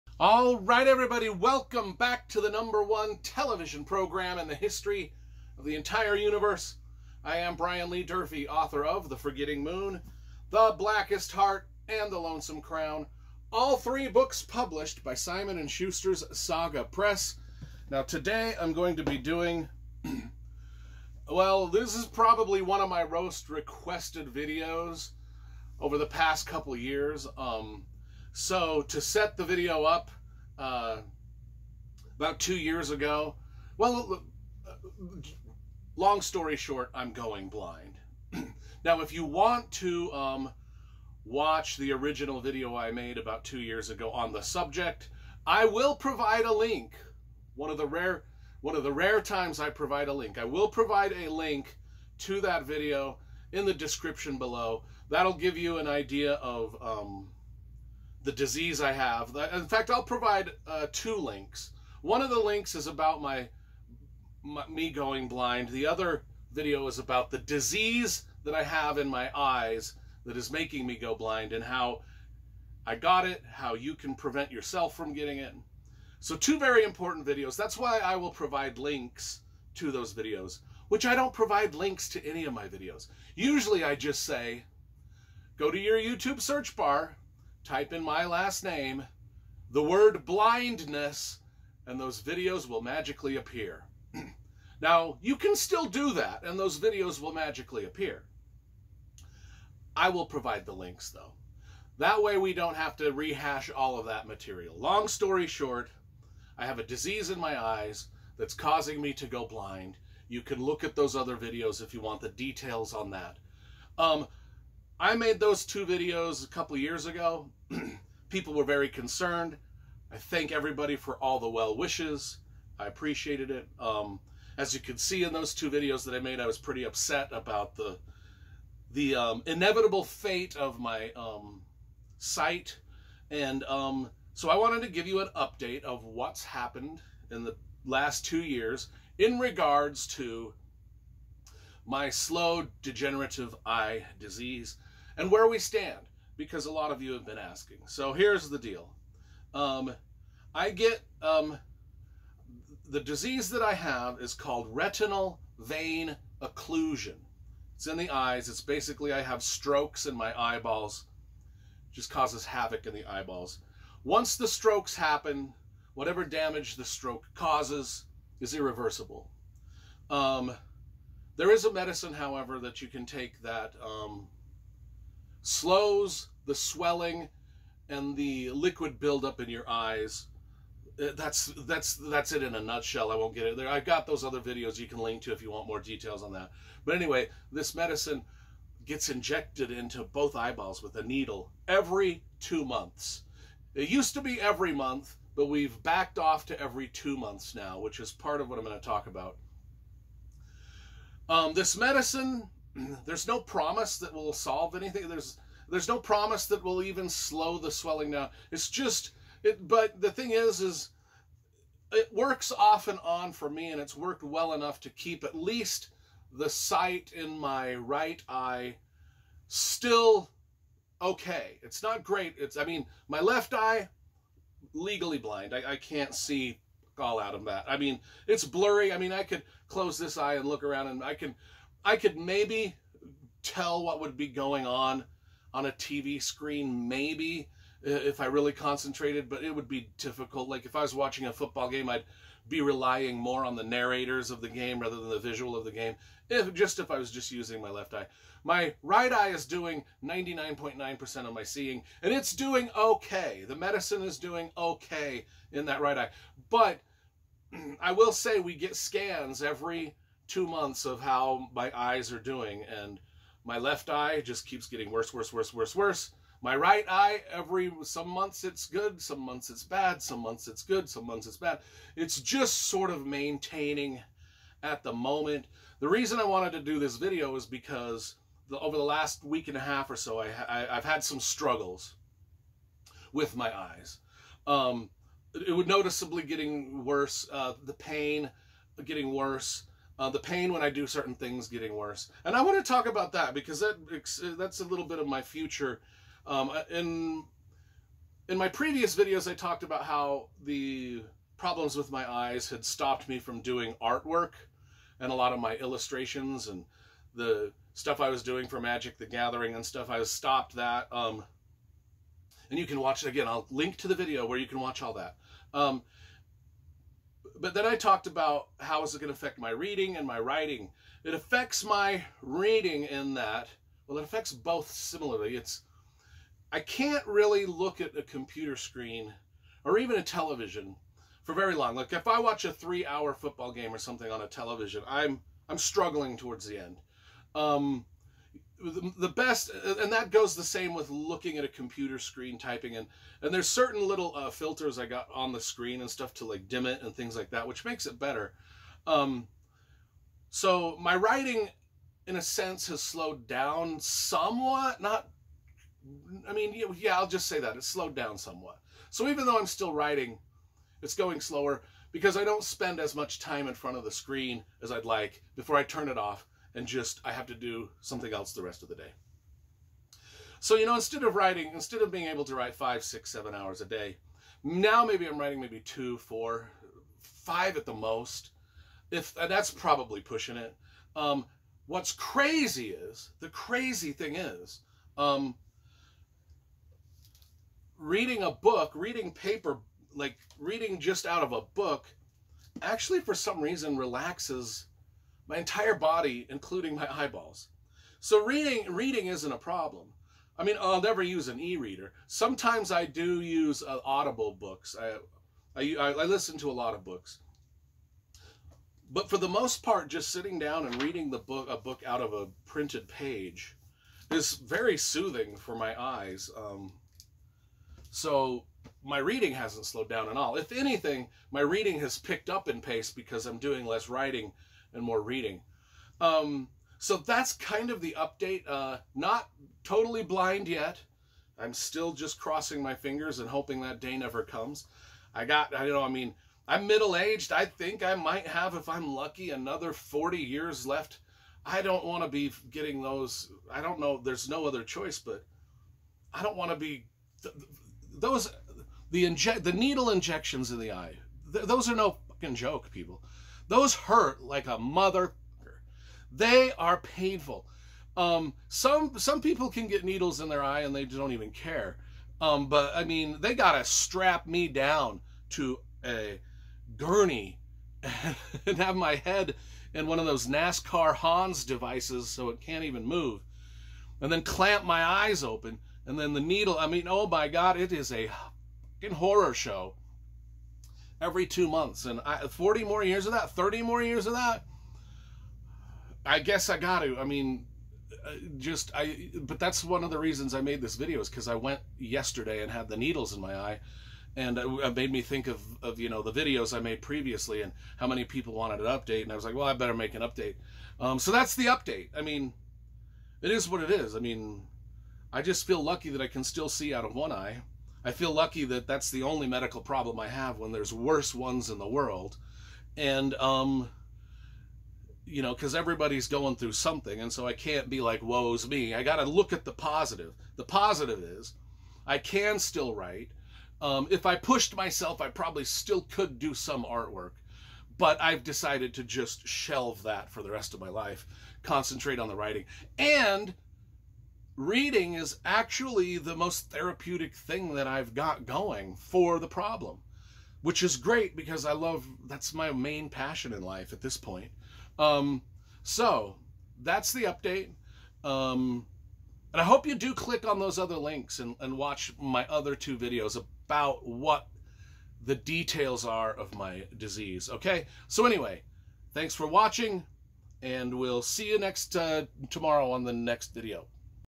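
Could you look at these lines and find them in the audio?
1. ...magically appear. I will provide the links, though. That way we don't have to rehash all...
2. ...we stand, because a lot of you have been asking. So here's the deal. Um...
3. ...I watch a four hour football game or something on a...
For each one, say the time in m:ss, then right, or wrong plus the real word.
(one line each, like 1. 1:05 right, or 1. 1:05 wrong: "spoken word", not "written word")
1. 1:37 right
2. 2:25 right
3. 5:32 wrong: "three", not "four".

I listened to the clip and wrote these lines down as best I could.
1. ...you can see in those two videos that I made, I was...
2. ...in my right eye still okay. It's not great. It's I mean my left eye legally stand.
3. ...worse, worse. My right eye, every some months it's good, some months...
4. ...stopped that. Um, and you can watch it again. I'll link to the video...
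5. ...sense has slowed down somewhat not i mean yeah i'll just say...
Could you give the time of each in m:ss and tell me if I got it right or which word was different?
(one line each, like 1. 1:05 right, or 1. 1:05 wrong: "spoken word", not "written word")
1. 2:04 right
2. 3:37 wrong: "blind", not "stand"
3. 4:25 right
4. 5:10 right
5. 5:52 right.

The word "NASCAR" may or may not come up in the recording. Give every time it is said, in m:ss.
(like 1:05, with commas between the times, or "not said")
7:50.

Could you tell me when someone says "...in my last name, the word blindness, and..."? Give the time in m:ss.
1:27.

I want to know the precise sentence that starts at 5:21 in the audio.
It affects my reading in that, well, it affects both similarly.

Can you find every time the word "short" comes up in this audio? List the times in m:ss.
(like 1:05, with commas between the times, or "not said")
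0:36, 1:45.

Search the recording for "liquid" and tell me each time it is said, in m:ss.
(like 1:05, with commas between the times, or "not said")
2:58.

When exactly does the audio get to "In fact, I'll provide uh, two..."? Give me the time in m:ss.
0:59.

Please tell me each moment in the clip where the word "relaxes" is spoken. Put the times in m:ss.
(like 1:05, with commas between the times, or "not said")
6:33.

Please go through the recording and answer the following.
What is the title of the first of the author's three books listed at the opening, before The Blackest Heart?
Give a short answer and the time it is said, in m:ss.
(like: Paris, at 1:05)
The Forgetting Moon, at 0:09.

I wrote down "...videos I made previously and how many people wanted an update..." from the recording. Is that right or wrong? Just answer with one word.
right.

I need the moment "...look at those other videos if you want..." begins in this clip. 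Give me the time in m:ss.
1:50.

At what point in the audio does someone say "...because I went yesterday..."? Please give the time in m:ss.
8:11.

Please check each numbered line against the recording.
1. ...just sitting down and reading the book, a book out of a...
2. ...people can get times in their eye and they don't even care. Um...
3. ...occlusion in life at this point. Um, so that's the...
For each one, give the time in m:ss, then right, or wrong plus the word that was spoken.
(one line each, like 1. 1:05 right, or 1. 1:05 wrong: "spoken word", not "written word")
1. 6:49 right
2. 7:39 wrong: "needles", not "times"
3. 9:02 wrong: "passion", not "occlusion".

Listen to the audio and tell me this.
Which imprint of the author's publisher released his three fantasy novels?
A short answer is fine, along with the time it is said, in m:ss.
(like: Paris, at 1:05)
Saga Press, at 0:16.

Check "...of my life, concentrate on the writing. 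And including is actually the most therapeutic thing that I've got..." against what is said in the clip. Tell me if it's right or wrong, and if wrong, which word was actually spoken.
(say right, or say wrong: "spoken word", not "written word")
wrong: "reading", not "including".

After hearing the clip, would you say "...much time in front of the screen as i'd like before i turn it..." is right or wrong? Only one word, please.
right.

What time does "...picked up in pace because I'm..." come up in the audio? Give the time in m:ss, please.
7:01.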